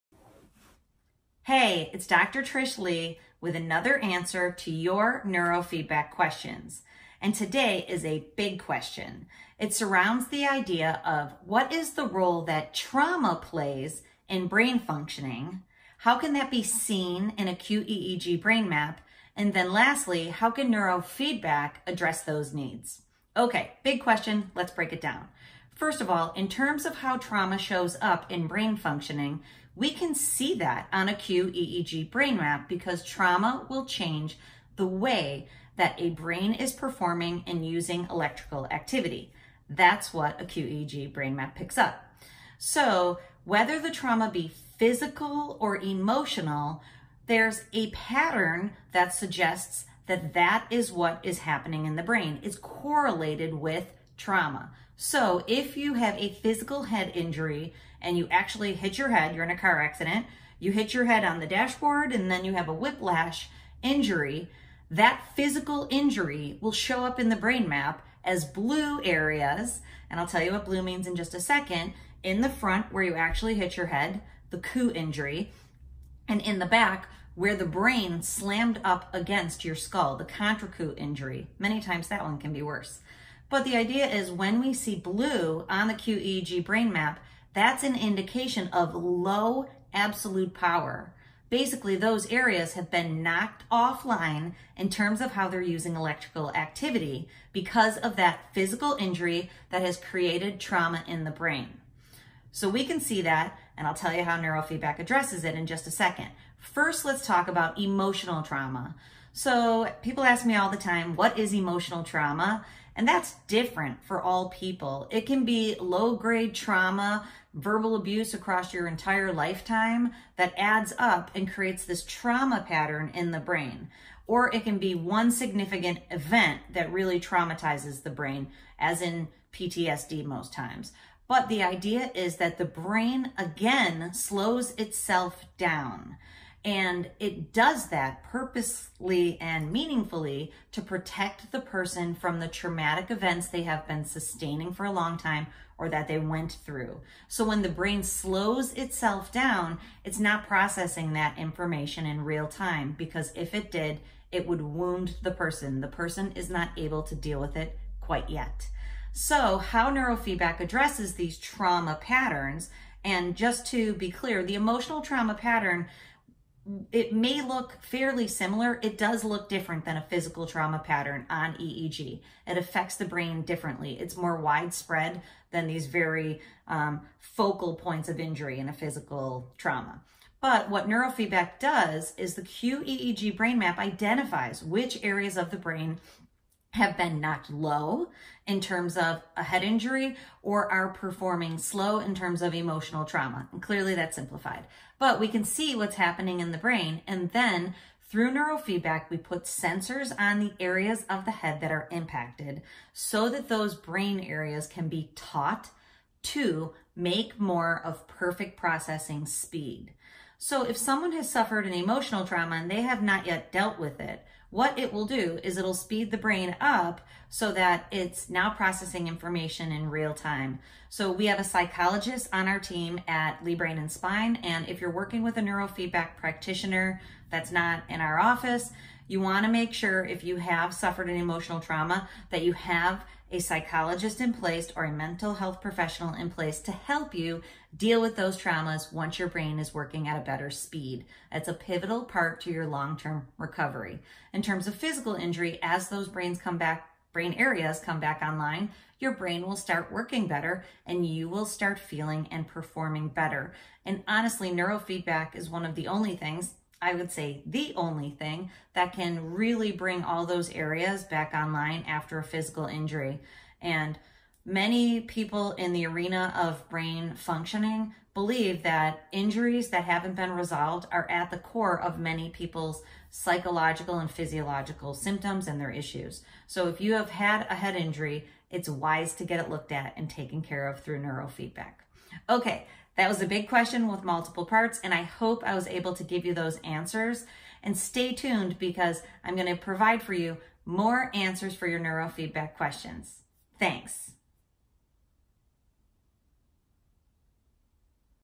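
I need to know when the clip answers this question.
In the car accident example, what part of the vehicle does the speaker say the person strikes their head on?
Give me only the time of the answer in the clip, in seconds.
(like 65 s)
61 s.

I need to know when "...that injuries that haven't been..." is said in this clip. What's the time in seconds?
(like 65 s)
268 s.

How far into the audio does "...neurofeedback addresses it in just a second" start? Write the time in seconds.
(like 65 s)
104 s.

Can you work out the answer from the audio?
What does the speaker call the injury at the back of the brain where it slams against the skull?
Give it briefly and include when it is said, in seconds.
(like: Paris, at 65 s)
Contra coup injury, at 80 s.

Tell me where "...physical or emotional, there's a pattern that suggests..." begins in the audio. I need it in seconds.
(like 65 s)
44 s.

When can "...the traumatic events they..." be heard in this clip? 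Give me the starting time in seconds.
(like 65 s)
142 s.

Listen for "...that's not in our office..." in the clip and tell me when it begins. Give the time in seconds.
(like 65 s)
227 s.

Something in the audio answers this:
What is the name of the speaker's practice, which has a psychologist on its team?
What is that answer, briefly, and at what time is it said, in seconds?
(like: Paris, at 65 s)
Leigh Brain and Spine, at 223 s.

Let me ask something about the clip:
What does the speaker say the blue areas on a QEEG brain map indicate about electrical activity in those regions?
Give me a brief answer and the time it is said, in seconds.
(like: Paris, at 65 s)
Low absolute power, at 88 s.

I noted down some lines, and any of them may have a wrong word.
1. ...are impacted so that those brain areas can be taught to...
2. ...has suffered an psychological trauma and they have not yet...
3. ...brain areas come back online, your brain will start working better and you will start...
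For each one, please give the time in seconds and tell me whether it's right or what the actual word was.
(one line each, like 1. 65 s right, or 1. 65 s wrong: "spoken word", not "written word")
1. 201 s right
2. 211 s wrong: "emotional", not "psychological"
3. 247 s right.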